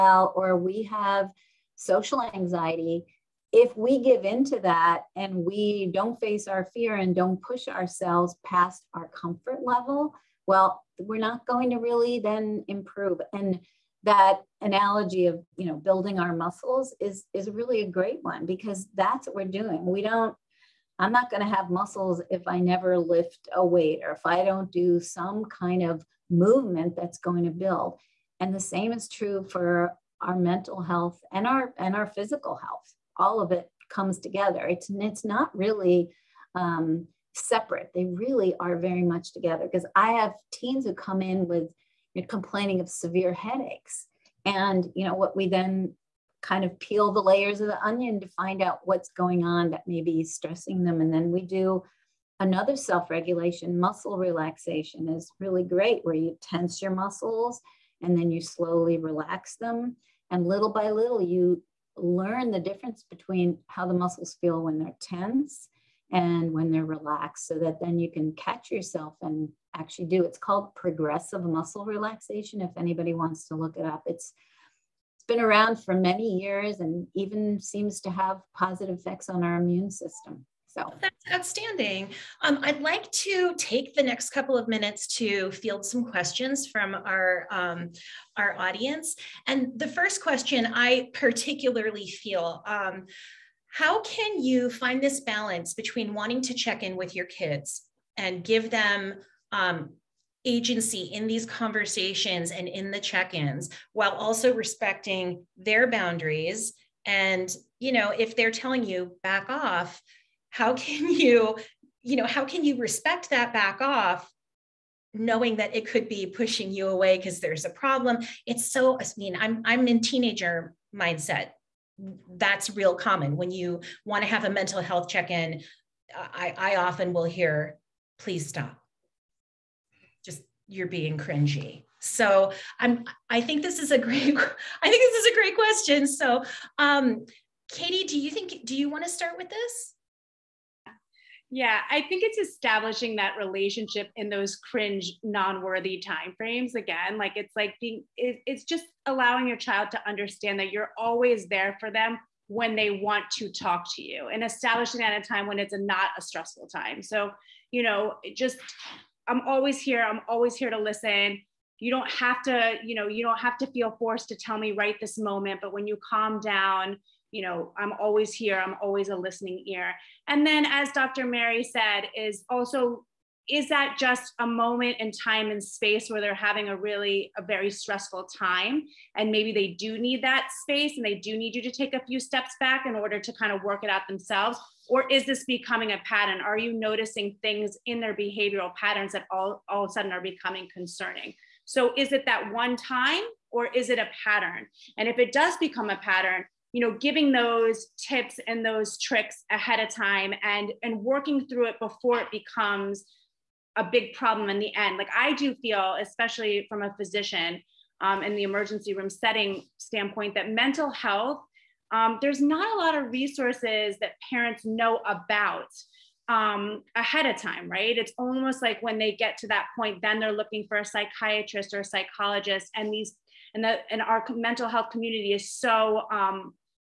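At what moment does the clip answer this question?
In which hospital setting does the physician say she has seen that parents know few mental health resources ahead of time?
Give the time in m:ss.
3:28.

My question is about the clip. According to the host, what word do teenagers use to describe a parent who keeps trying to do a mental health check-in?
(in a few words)
Cringy.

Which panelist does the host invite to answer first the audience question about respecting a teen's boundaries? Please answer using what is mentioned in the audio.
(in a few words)
Katie.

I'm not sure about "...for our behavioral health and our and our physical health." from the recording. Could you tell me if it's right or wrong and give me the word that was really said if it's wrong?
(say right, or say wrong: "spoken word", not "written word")
wrong: "mental", not "behavioral".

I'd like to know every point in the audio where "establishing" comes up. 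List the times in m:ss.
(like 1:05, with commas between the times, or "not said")
2:22, 2:34.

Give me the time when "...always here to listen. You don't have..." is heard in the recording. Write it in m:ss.
2:40.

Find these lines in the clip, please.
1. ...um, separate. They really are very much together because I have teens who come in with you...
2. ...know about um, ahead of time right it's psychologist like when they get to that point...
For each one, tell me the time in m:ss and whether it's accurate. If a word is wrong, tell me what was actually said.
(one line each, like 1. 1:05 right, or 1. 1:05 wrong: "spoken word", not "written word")
1. 0:36 right
2. 3:34 wrong: "almost", not "psychologist".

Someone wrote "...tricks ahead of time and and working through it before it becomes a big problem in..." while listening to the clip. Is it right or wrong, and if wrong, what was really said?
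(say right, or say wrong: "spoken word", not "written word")
right.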